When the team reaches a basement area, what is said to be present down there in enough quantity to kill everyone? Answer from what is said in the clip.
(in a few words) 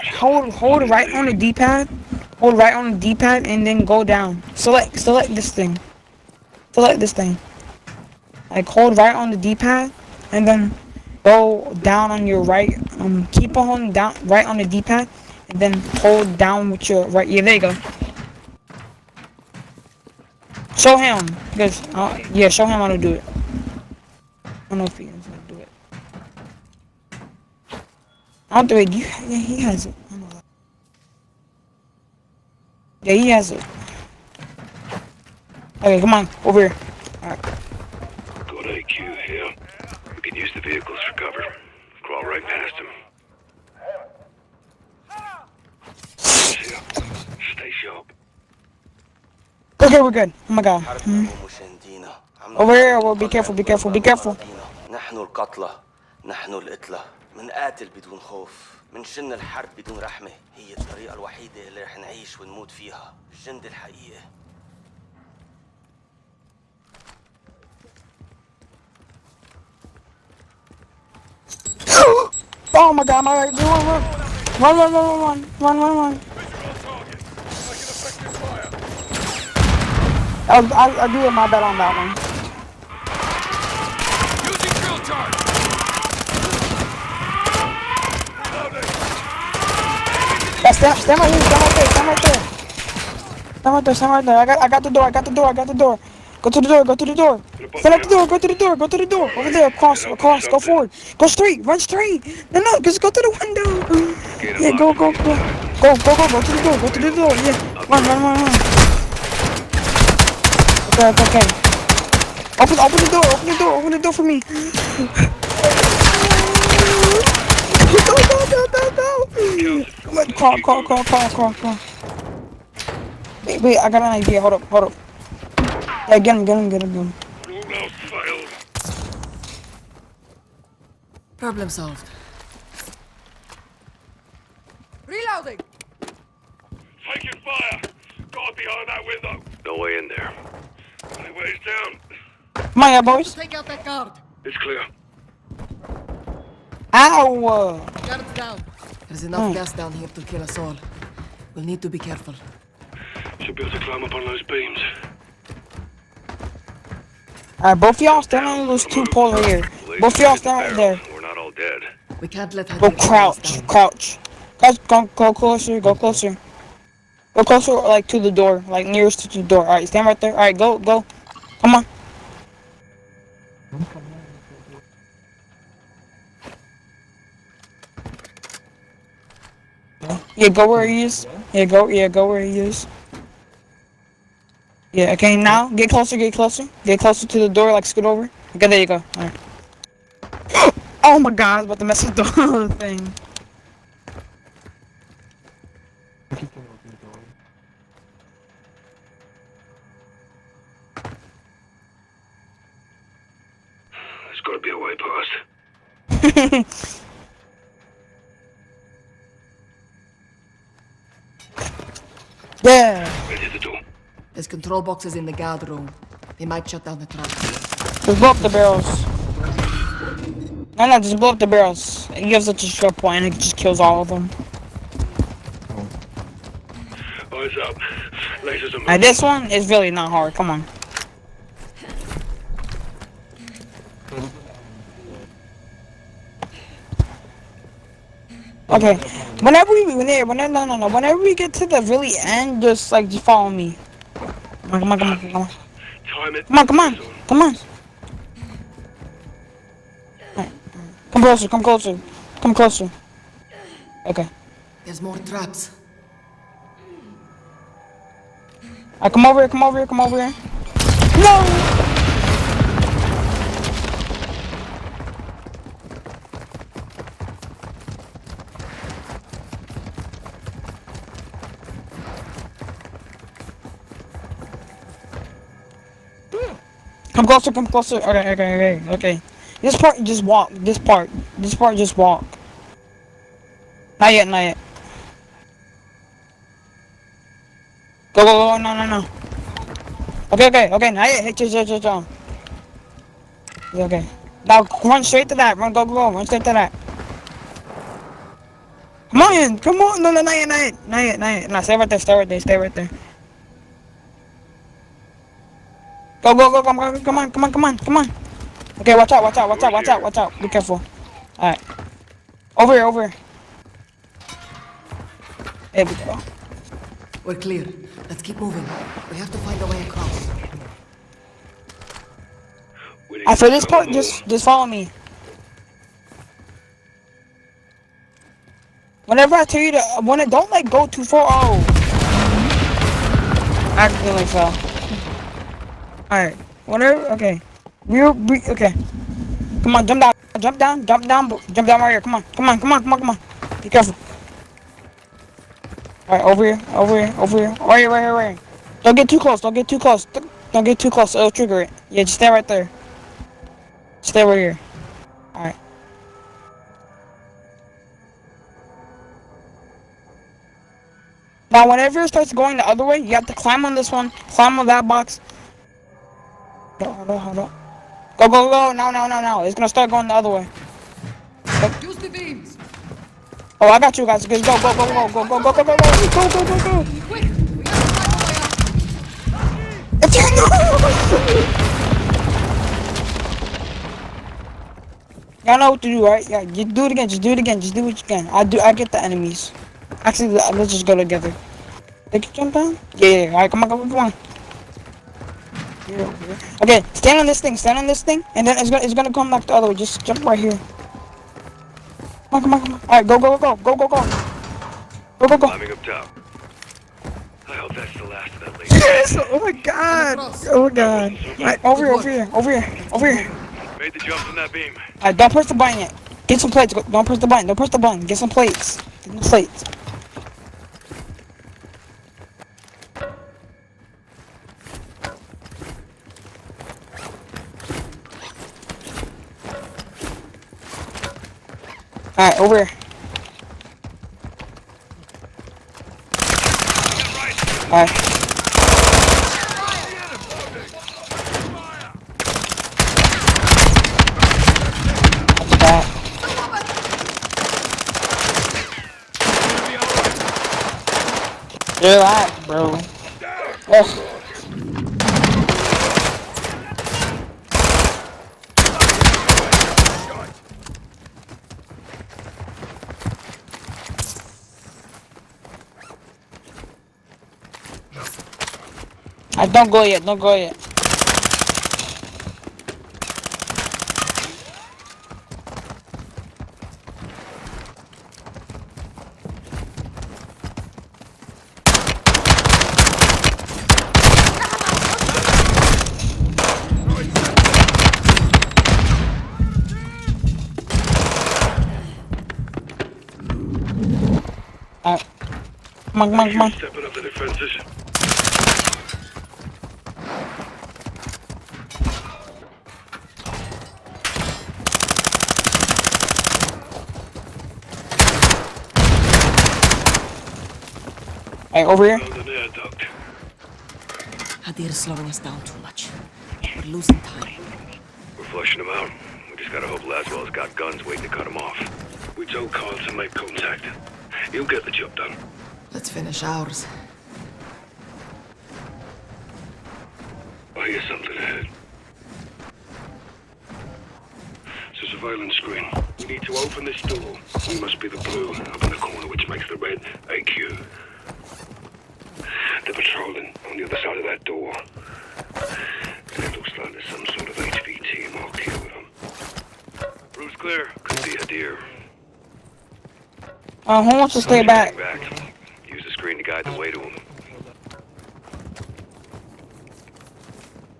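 Gas.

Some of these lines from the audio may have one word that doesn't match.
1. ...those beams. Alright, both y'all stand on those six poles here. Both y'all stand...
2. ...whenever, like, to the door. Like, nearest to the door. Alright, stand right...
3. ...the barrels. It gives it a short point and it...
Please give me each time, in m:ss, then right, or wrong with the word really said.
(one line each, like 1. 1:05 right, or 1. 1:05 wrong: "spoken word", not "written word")
1. 2:34 wrong: "two", not "six"
2. 2:47 wrong: "closer", not "whenever"
3. 3:41 right.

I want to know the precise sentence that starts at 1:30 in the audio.
Yeah, stand, stand right here, stand right there, stand right there.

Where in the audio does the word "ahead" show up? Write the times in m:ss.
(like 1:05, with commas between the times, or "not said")
8:51.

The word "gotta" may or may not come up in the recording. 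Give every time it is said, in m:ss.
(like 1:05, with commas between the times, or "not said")
3:24, 8:39.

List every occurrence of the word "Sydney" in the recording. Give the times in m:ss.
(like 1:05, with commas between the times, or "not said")
not said.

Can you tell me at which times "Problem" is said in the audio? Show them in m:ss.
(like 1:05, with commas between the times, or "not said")
2:11.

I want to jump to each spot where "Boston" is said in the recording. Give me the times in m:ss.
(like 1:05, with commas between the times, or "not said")
not said.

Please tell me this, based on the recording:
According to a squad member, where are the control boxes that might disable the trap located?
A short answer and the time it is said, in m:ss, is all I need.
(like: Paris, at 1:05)
The guard room, at 3:35.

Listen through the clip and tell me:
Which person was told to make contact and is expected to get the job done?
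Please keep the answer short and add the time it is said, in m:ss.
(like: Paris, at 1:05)
Carl, at 8:42.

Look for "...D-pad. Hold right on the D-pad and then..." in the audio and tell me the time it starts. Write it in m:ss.
0:01.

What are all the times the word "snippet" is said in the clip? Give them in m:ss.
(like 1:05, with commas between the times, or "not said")
not said.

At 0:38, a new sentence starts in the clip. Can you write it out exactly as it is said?
We can use the vehicles for cover.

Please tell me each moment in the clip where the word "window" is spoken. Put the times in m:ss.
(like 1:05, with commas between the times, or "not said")
1:43, 2:19.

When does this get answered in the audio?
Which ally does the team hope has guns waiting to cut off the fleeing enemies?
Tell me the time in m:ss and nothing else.
8:39.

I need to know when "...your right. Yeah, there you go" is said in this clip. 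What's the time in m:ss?
0:16.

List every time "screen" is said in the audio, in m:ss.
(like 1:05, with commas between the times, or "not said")
8:55, 9:15.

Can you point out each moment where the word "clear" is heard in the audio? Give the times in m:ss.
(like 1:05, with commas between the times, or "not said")
2:24, 5:17, 9:10.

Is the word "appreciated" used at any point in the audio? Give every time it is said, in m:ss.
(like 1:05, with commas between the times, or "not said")
not said.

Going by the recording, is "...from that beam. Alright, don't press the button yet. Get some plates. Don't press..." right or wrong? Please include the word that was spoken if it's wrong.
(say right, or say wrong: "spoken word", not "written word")
right.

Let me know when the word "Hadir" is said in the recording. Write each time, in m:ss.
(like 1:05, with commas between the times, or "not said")
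8:34, 9:11.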